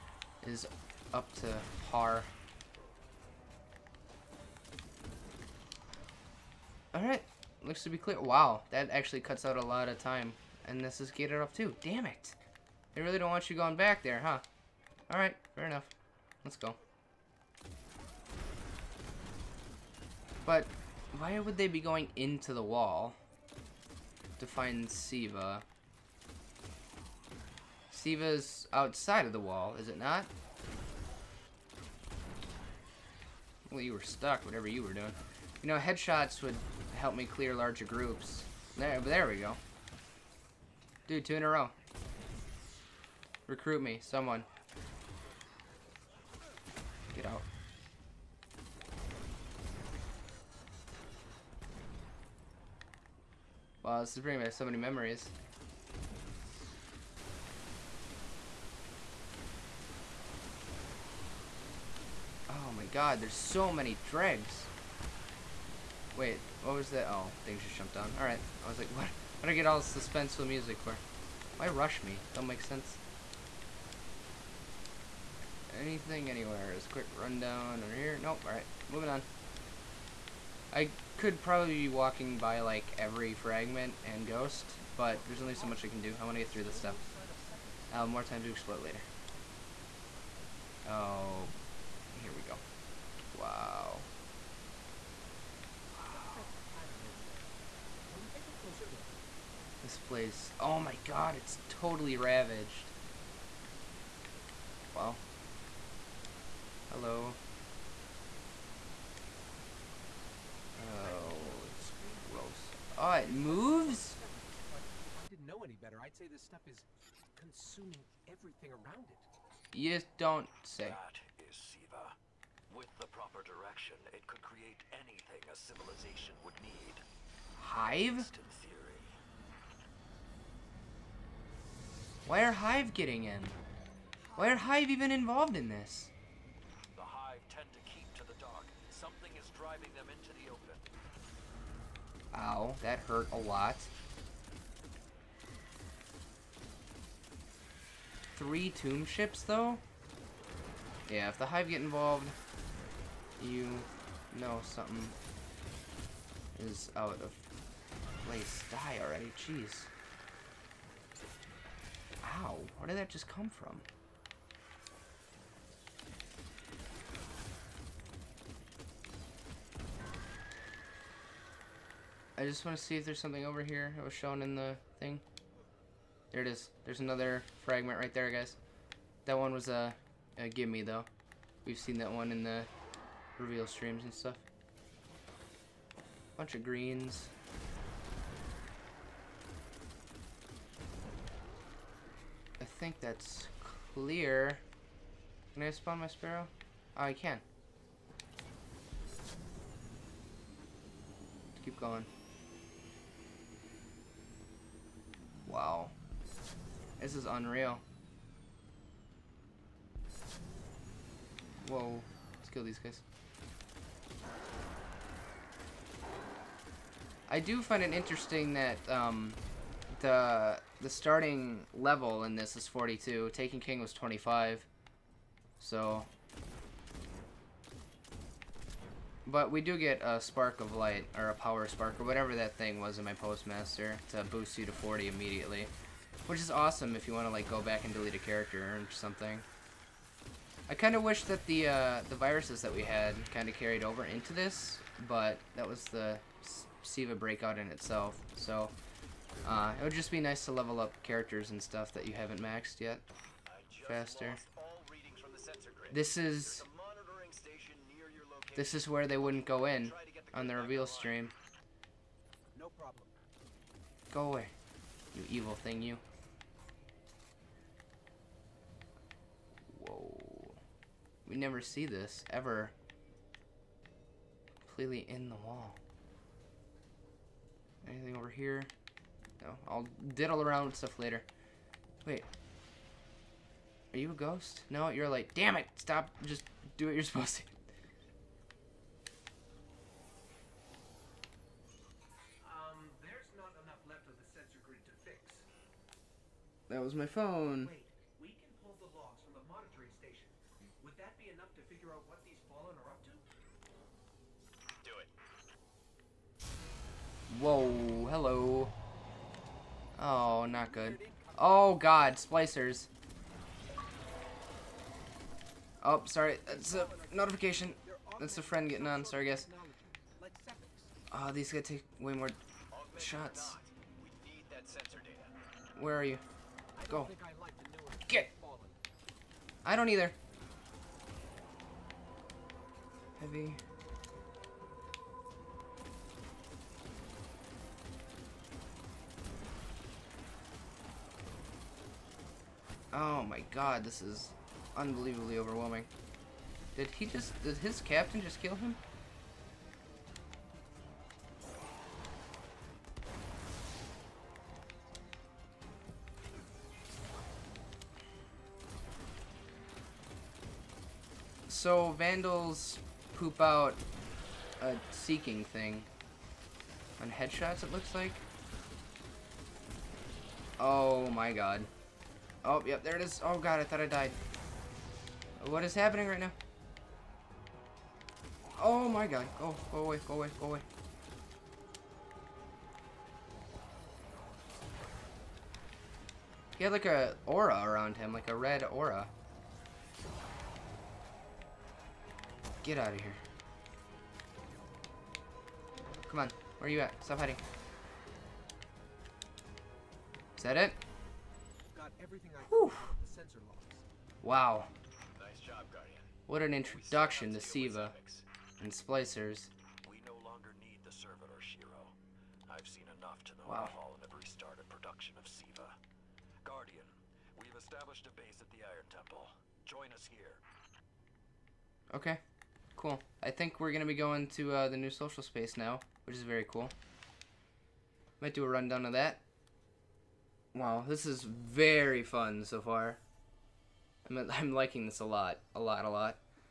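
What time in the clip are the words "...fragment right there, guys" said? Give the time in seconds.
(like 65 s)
177 s.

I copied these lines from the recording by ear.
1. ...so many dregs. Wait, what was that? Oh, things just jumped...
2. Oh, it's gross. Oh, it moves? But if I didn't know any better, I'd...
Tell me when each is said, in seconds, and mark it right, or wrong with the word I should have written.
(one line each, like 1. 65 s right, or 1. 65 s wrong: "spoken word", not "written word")
1. 63 s right
2. 110 s right.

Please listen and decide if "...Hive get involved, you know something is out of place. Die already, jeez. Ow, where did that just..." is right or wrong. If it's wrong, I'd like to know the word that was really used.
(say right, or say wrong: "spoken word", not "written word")
right.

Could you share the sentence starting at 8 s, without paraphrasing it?
Wow, that actually cuts out a lot of time.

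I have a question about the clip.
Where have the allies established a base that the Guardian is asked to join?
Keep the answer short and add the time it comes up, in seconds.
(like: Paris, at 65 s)
The Iron Temple, at 418 s.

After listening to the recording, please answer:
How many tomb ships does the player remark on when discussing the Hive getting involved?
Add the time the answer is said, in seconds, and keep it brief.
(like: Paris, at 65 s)
3, at 148 s.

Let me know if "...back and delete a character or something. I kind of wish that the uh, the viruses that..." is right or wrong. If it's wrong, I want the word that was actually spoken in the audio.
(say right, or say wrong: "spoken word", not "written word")
right.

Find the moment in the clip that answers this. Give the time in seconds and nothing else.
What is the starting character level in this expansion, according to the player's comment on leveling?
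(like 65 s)
222 s.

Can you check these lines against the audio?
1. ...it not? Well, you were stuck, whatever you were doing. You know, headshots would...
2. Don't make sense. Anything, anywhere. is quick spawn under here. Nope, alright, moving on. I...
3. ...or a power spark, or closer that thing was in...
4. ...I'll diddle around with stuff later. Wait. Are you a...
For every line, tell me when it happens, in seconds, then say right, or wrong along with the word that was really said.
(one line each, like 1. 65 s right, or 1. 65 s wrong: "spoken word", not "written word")
1. 29 s right
2. 72 s wrong: "rundown", not "spawn"
3. 231 s wrong: "whatever", not "closer"
4. 279 s right.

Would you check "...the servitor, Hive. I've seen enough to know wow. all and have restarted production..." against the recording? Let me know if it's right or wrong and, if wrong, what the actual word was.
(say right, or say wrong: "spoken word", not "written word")
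wrong: "Shiro", not "Hive".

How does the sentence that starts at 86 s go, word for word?
I want to get through this stuff.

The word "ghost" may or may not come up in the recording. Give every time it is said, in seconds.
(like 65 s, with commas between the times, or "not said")
84 s, 284 s.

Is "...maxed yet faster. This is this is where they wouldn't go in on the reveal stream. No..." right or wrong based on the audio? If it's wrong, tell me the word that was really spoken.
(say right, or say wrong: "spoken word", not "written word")
right.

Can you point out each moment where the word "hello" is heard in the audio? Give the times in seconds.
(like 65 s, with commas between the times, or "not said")
106 s, 308 s.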